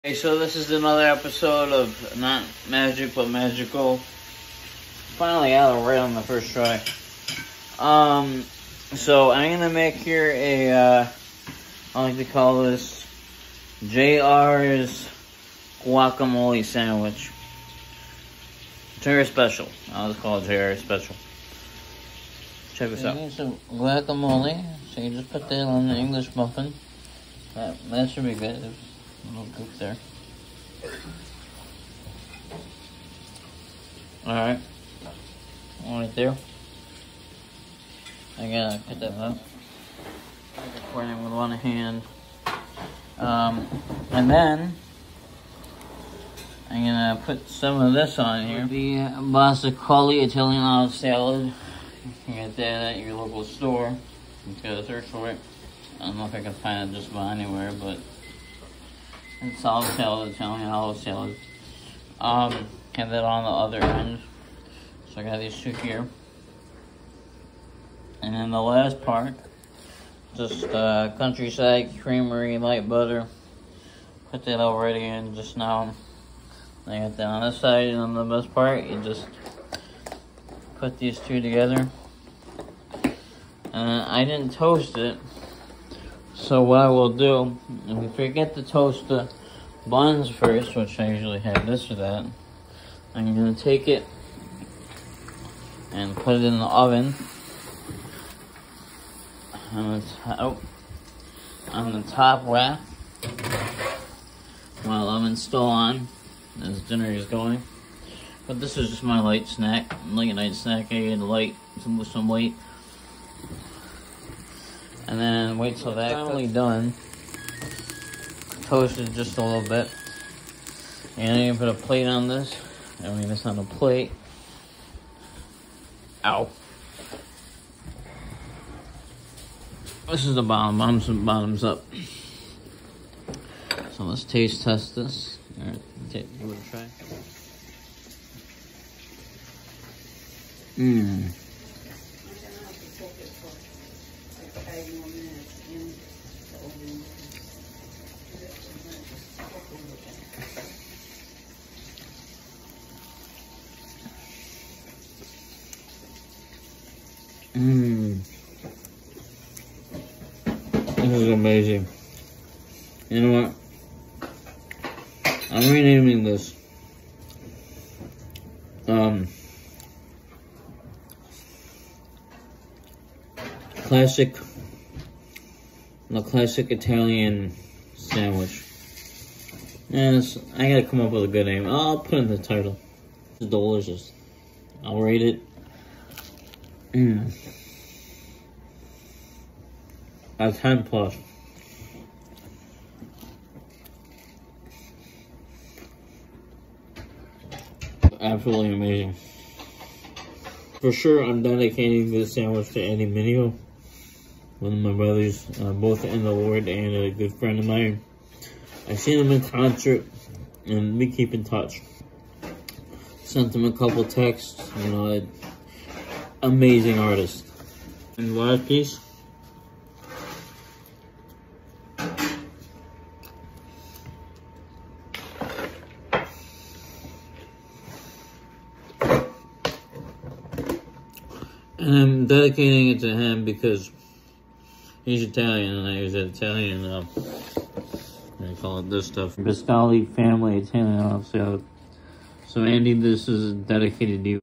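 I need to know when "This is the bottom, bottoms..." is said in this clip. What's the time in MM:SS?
02:10.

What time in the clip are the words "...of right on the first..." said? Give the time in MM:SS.
00:05.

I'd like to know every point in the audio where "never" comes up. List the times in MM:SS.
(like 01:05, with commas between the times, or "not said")
not said.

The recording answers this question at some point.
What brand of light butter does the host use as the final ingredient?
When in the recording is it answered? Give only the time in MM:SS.
01:11.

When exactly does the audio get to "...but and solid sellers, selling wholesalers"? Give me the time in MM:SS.
00:57.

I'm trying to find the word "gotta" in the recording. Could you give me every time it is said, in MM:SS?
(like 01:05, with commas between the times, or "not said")
00:38, 03:00.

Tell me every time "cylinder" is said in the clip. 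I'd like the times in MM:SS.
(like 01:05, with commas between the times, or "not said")
not said.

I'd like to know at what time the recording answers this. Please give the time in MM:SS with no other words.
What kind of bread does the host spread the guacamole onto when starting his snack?
00:25.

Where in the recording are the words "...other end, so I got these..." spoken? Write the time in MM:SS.
01:03.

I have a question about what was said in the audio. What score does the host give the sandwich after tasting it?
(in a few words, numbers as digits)
10 plus.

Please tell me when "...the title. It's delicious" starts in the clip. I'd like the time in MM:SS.
03:02.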